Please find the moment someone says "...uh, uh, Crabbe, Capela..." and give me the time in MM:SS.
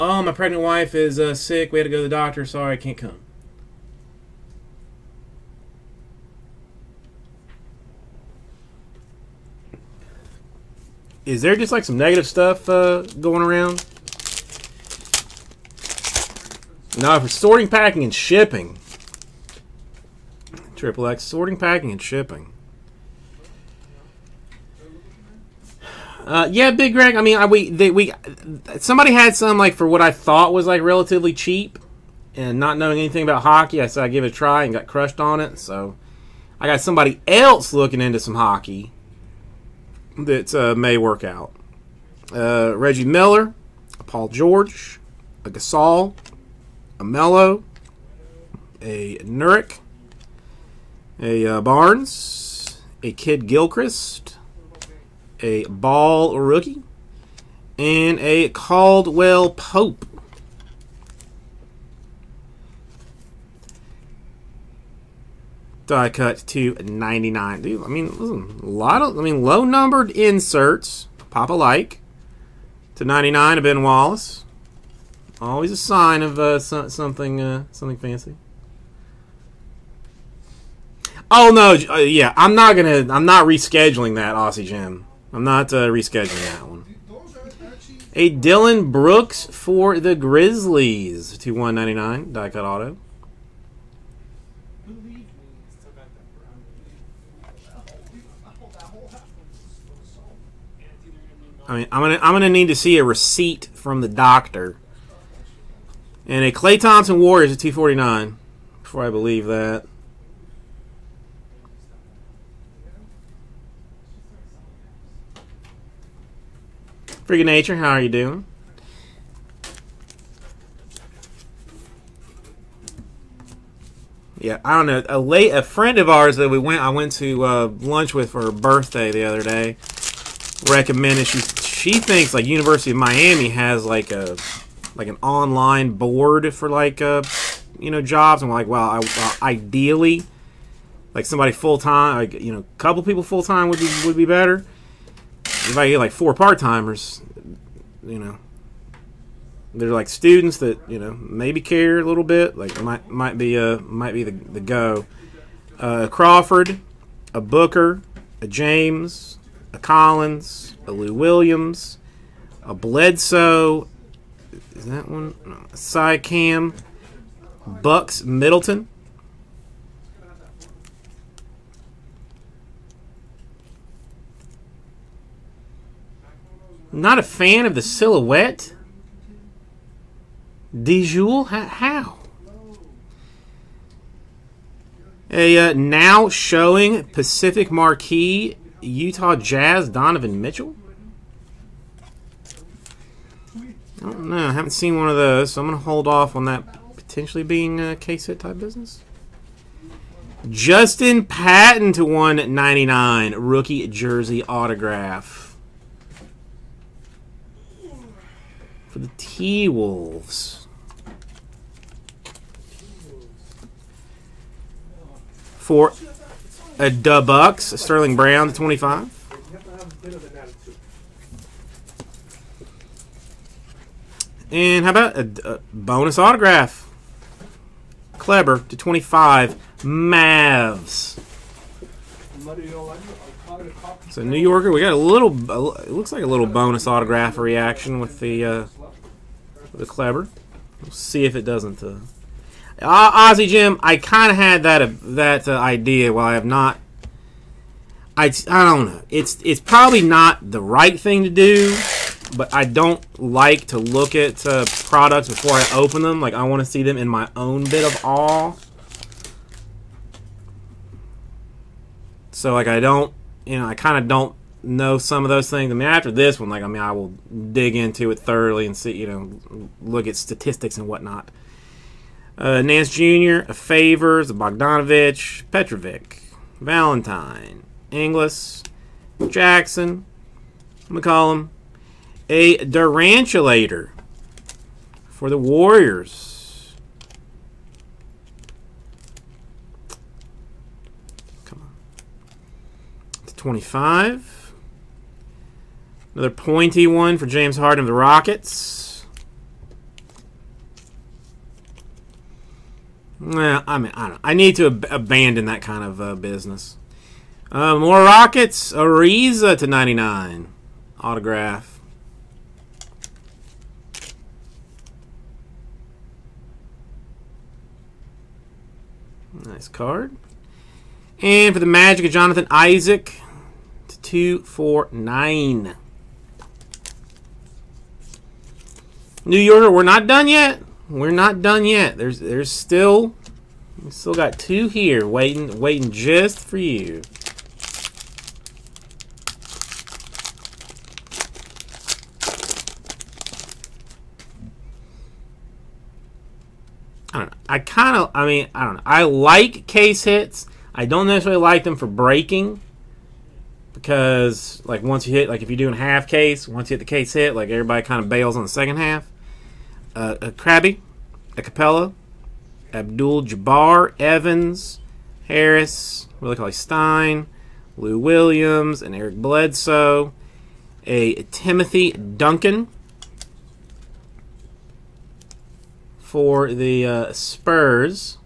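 05:59.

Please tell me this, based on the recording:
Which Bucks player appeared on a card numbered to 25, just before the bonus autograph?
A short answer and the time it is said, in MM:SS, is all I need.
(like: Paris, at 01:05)
Sterling Brown, at 03:37.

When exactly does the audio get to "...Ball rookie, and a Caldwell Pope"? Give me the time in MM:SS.
00:55.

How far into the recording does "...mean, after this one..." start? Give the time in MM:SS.
04:25.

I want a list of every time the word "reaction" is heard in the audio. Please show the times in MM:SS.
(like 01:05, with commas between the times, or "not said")
03:57.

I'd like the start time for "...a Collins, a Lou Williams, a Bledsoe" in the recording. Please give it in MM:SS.
02:39.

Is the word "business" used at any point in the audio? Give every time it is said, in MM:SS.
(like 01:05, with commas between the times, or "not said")
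03:18, 05:06.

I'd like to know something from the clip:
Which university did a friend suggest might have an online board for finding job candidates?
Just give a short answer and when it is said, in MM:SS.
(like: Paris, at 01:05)
University of Miami, at 02:12.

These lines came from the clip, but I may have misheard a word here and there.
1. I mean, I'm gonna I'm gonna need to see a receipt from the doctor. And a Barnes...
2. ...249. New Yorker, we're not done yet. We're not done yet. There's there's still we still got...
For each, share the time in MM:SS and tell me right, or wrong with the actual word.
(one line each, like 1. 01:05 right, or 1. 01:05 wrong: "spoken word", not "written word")
1. 01:41 wrong: "Klay", not "Barnes"
2. 05:24 right.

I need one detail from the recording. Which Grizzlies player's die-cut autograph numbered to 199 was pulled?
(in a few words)
Dillon Brooks.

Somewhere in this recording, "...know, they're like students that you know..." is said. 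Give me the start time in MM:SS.
02:28.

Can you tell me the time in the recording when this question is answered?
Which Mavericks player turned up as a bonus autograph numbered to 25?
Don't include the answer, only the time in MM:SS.
03:48.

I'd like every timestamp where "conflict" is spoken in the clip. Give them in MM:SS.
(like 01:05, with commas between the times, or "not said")
not said.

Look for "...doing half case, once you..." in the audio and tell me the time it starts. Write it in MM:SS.
05:55.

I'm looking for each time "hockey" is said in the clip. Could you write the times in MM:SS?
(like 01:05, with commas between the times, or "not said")
00:33, 00:38.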